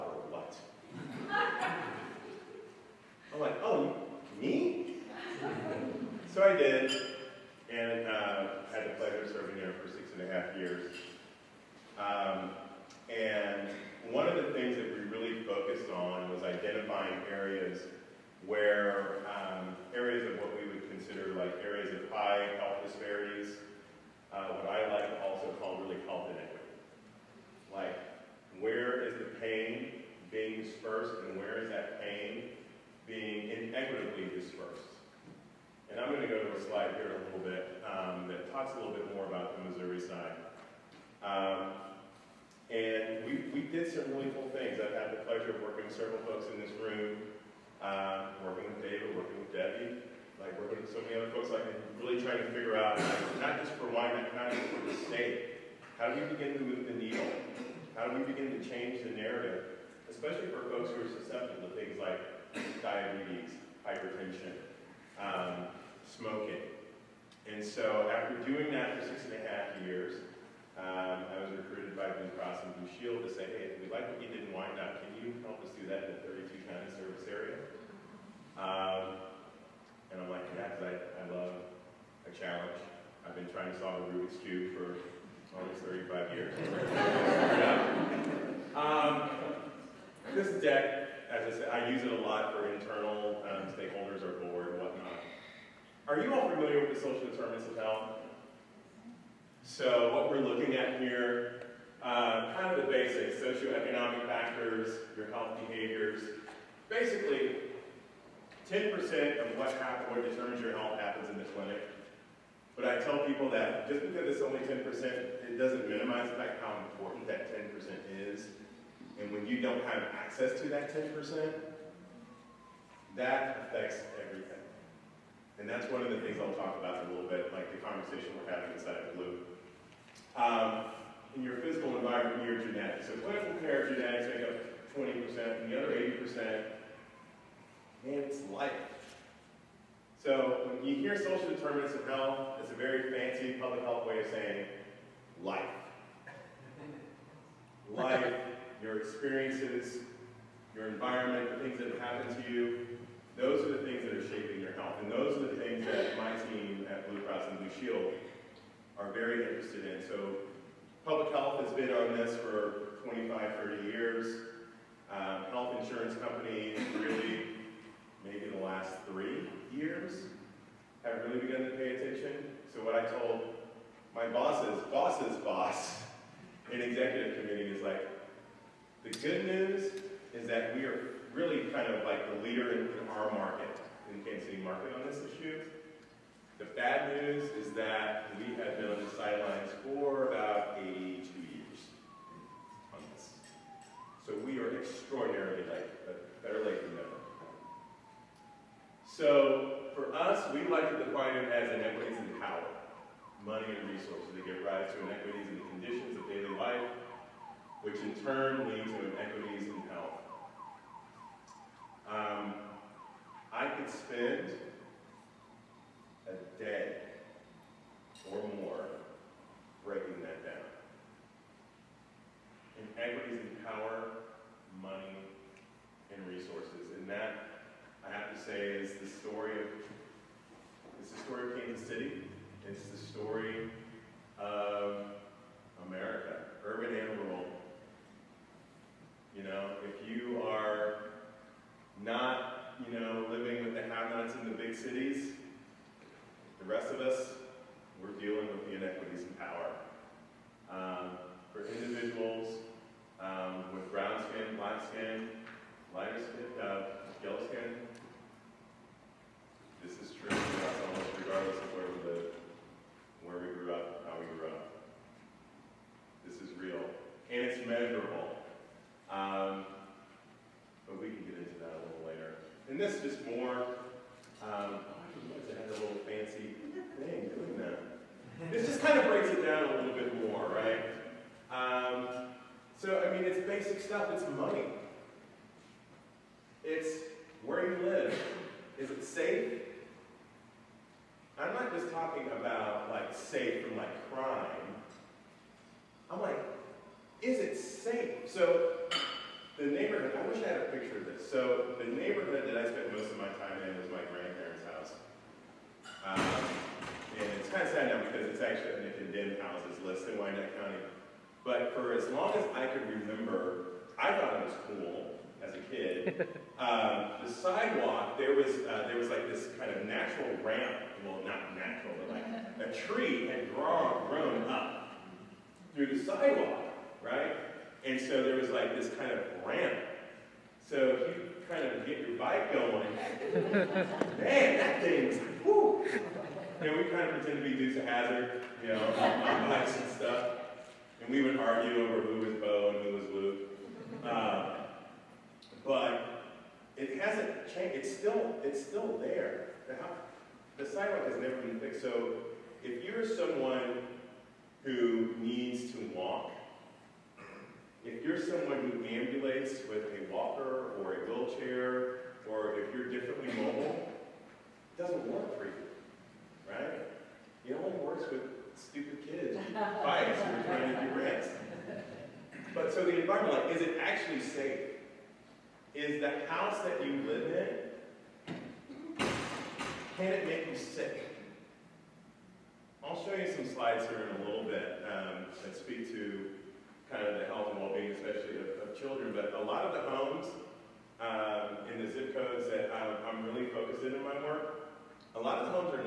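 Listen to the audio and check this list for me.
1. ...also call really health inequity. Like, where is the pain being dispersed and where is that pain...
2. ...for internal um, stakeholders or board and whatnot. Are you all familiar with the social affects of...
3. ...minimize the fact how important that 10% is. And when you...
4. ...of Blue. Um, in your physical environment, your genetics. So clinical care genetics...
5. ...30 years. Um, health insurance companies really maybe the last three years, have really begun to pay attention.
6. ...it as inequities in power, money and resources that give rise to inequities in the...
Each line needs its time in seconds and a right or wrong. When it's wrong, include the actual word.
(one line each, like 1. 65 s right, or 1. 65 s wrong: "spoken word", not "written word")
1. 25 s right
2. 92 s wrong: "determinants", not "affects"
3. 115 s right
4. 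129 s right
5. 163 s right
6. 201 s right.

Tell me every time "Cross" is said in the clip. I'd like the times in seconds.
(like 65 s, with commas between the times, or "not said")
72 s, 157 s.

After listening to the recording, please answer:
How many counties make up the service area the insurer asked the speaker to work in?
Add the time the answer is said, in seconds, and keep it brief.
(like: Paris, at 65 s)
32, at 76 s.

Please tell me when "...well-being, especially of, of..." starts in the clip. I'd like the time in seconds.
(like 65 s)
387 s.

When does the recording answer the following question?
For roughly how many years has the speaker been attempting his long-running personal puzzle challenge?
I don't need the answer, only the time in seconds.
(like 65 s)
85 s.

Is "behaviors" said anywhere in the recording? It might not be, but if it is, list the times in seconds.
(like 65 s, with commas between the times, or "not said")
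105 s.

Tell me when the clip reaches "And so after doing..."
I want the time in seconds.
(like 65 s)
67 s.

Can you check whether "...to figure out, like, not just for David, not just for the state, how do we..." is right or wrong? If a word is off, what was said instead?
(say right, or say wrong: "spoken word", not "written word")
wrong: "Wyman", not "David".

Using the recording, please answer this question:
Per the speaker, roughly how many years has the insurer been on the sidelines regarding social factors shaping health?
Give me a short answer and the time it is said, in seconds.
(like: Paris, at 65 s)
82 years, at 190 s.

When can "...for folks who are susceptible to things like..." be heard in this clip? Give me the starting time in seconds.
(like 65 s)
60 s.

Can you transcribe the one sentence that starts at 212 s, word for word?
Um, I could spend a day or more breaking that down.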